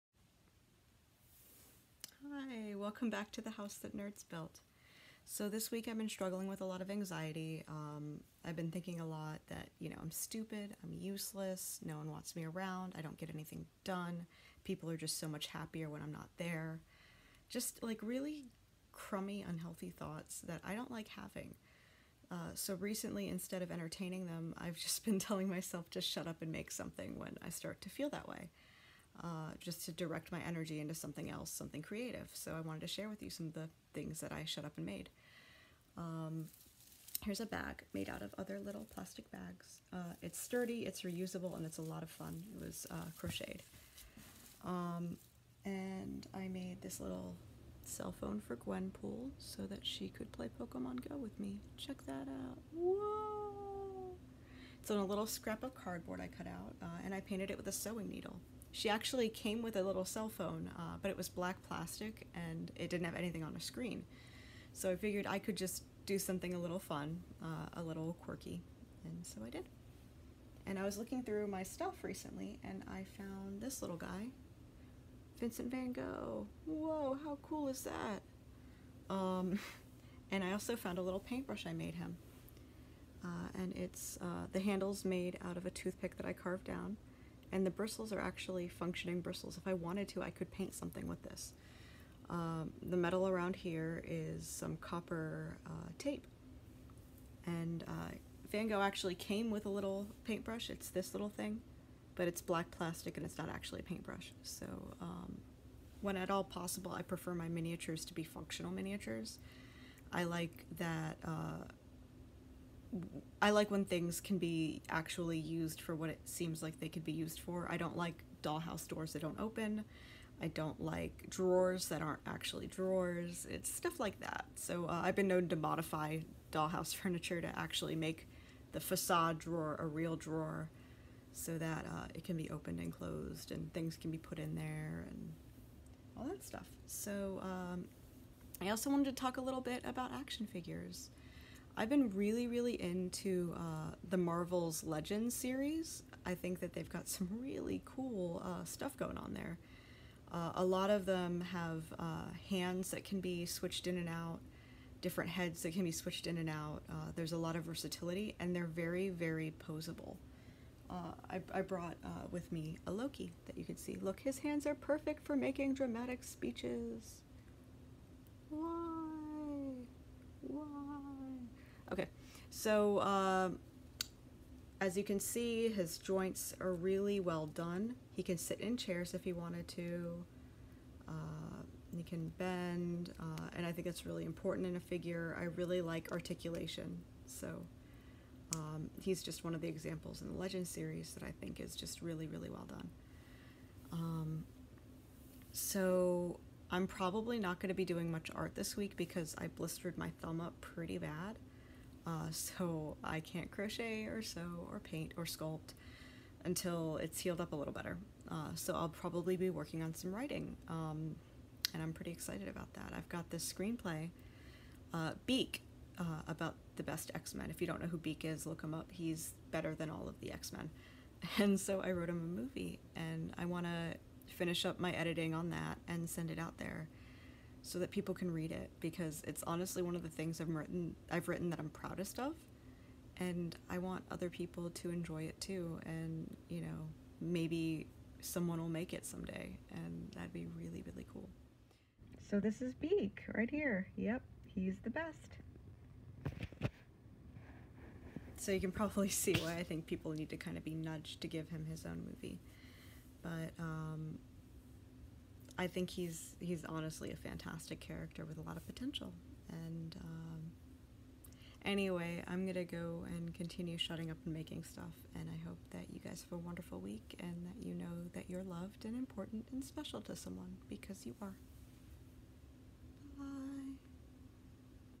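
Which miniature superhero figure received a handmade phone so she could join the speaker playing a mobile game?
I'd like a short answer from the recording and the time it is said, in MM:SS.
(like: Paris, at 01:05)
Gwenpool, at 00:48.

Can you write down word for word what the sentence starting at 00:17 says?
Just like really crummy, unhealthy thoughts that I don't like having.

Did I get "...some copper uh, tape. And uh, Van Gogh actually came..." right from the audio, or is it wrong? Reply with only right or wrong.
right.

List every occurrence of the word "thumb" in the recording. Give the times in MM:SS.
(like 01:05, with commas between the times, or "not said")
03:20.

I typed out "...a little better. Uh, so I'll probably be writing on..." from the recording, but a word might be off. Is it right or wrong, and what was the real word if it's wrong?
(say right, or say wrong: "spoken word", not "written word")
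wrong: "working", not "writing".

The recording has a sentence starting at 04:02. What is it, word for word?
So this is Beak right here.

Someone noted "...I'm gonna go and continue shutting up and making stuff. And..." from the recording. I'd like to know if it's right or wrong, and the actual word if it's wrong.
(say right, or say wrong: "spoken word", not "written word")
right.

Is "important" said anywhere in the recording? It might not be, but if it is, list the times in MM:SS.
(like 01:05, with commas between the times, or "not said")
03:04, 04:28.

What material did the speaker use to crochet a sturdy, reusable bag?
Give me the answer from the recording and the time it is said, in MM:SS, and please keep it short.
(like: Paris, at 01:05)
Plastic bags, at 00:38.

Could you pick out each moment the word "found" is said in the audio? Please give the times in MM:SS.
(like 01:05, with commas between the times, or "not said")
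01:13, 01:20.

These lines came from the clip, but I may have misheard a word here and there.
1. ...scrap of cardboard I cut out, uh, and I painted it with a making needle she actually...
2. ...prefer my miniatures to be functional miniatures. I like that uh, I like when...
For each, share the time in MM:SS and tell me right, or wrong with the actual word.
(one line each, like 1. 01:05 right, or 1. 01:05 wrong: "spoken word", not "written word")
1. 00:55 wrong: "sewing", not "making"
2. 01:47 right.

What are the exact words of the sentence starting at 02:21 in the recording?
I've been really, really into uh, the Marvel's Legends series.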